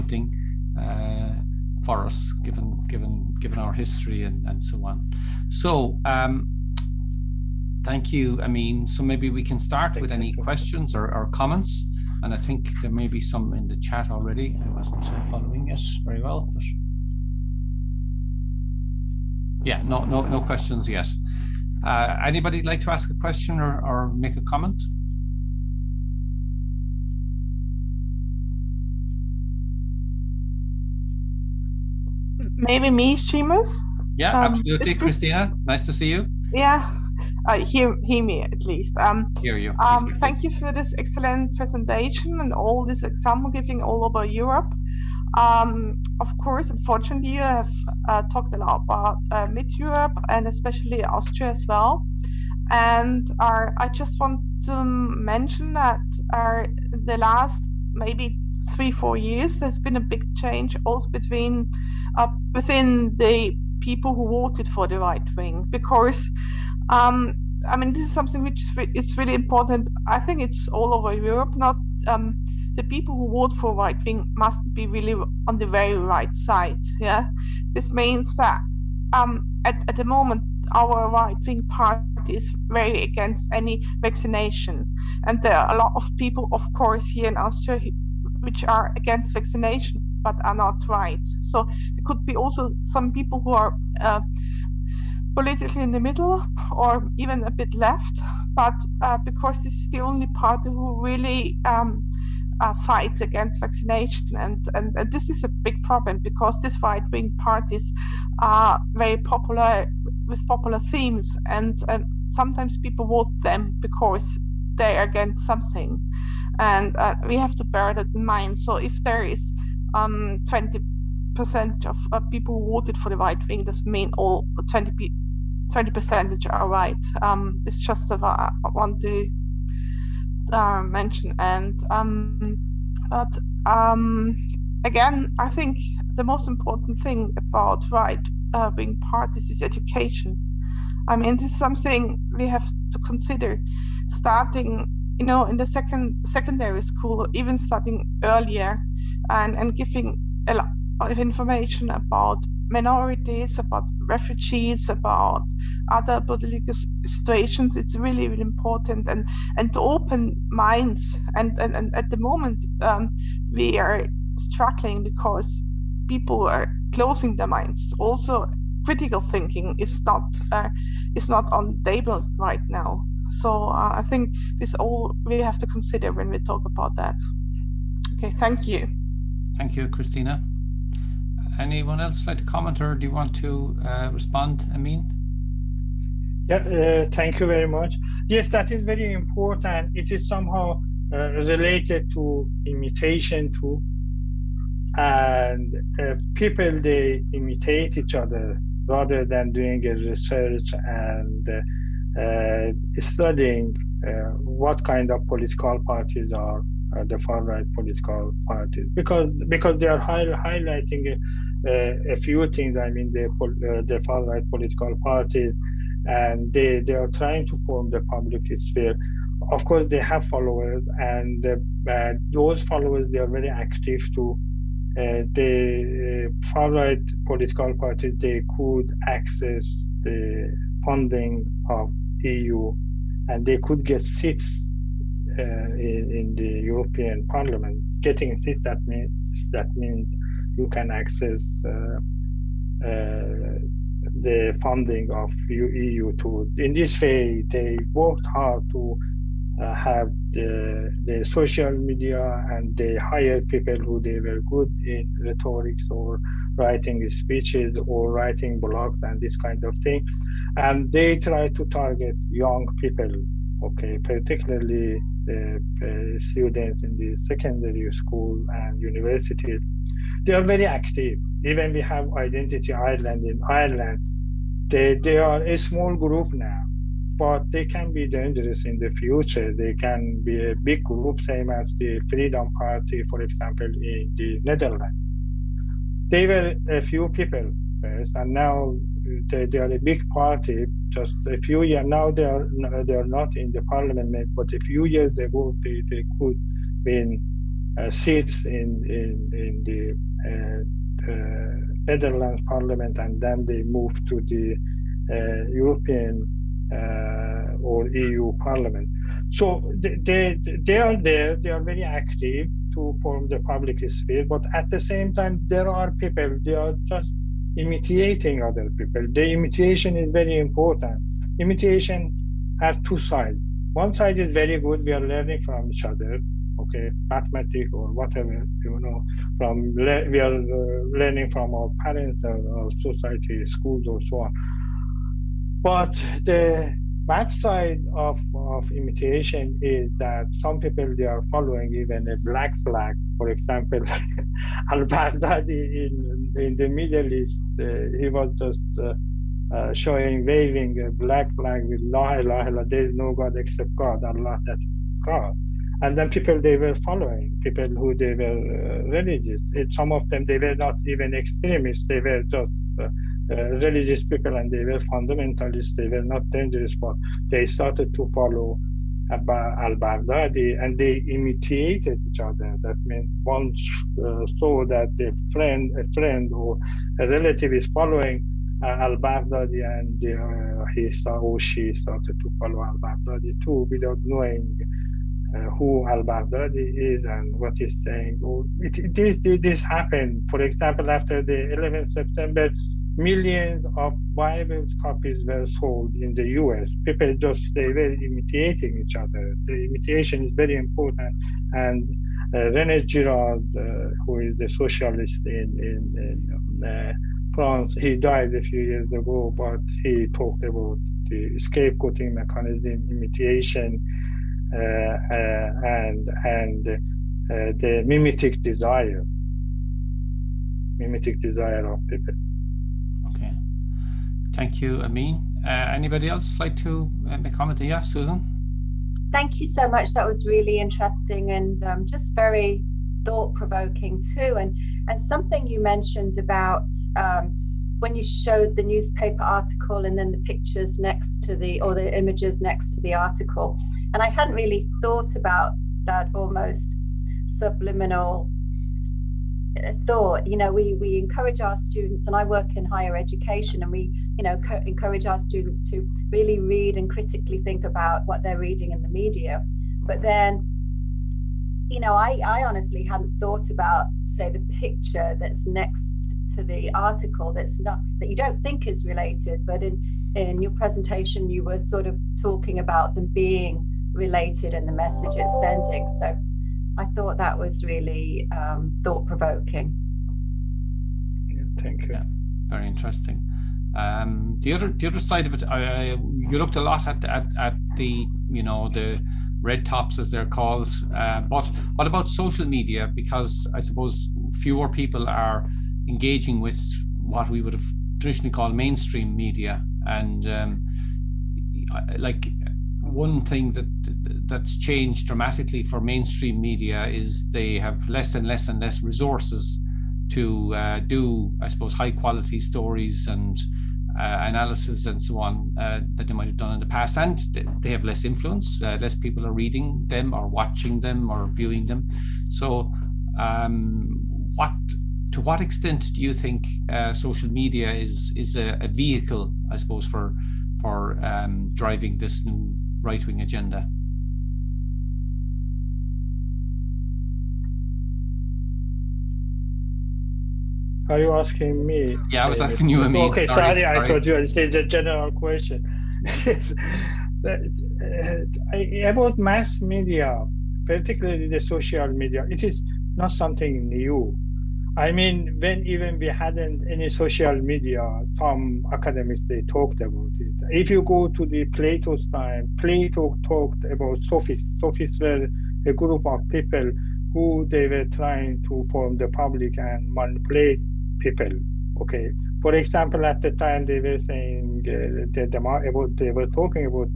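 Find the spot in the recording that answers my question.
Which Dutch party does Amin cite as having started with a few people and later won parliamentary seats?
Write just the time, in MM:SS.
04:42.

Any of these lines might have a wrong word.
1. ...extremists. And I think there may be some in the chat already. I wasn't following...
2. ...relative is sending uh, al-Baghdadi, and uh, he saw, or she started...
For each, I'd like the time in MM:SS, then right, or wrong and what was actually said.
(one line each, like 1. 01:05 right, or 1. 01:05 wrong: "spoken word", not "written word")
1. 00:11 wrong: "comments", not "extremists"
2. 06:17 wrong: "following", not "sending".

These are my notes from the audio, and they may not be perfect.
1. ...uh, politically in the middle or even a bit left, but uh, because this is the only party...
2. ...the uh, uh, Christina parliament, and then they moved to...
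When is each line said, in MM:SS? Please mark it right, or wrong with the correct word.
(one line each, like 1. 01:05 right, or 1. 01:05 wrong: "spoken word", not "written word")
1. 01:34 right
2. 04:59 wrong: "Netherlands", not "Christina".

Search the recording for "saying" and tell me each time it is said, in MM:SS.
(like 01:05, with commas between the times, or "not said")
06:27, 09:33.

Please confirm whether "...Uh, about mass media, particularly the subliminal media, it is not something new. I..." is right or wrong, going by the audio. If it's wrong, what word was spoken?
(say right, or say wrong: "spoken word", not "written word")
wrong: "social", not "subliminal".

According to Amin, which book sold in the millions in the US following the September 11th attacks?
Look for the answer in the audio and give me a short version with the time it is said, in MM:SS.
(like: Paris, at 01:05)
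Bible, at 06:34.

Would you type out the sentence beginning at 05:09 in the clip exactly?
So they, they they are there.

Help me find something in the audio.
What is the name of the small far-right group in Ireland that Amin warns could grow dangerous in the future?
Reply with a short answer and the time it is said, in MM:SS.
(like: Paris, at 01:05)
Identity Ireland, at 04:32.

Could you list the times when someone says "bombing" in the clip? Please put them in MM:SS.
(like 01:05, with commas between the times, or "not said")
not said.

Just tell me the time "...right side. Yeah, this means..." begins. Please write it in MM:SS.
01:15.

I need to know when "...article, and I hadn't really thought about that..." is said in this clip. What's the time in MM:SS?
07:22.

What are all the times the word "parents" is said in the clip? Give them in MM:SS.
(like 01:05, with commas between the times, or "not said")
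05:31.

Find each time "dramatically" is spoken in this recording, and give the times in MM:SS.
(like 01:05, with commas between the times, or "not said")
08:25.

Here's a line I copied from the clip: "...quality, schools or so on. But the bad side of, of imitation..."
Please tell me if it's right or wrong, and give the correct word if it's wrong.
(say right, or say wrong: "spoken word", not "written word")
wrong: "society", not "quality".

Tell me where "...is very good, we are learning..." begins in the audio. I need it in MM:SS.
05:24.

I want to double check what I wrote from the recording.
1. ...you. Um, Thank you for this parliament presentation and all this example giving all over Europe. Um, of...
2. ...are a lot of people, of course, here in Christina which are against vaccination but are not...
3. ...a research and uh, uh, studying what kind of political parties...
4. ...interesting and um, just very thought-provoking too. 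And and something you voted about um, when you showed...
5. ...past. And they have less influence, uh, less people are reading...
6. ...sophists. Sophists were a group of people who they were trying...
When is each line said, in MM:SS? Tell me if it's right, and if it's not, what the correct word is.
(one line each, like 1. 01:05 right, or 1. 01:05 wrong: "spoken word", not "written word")
1. 00:39 wrong: "excellent", not "parliament"
2. 01:25 wrong: "Austria", not "Christina"
3. 03:19 right
4. 07:10 wrong: "mentioned", not "voted"
5. 08:36 right
6. 09:24 right.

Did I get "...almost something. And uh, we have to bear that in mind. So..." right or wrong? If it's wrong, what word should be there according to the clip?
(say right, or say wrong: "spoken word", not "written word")
wrong: "against", not "almost".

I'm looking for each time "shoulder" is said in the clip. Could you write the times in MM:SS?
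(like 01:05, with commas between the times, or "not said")
not said.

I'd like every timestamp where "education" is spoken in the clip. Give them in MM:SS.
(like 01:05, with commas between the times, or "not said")
02:19, 07:32.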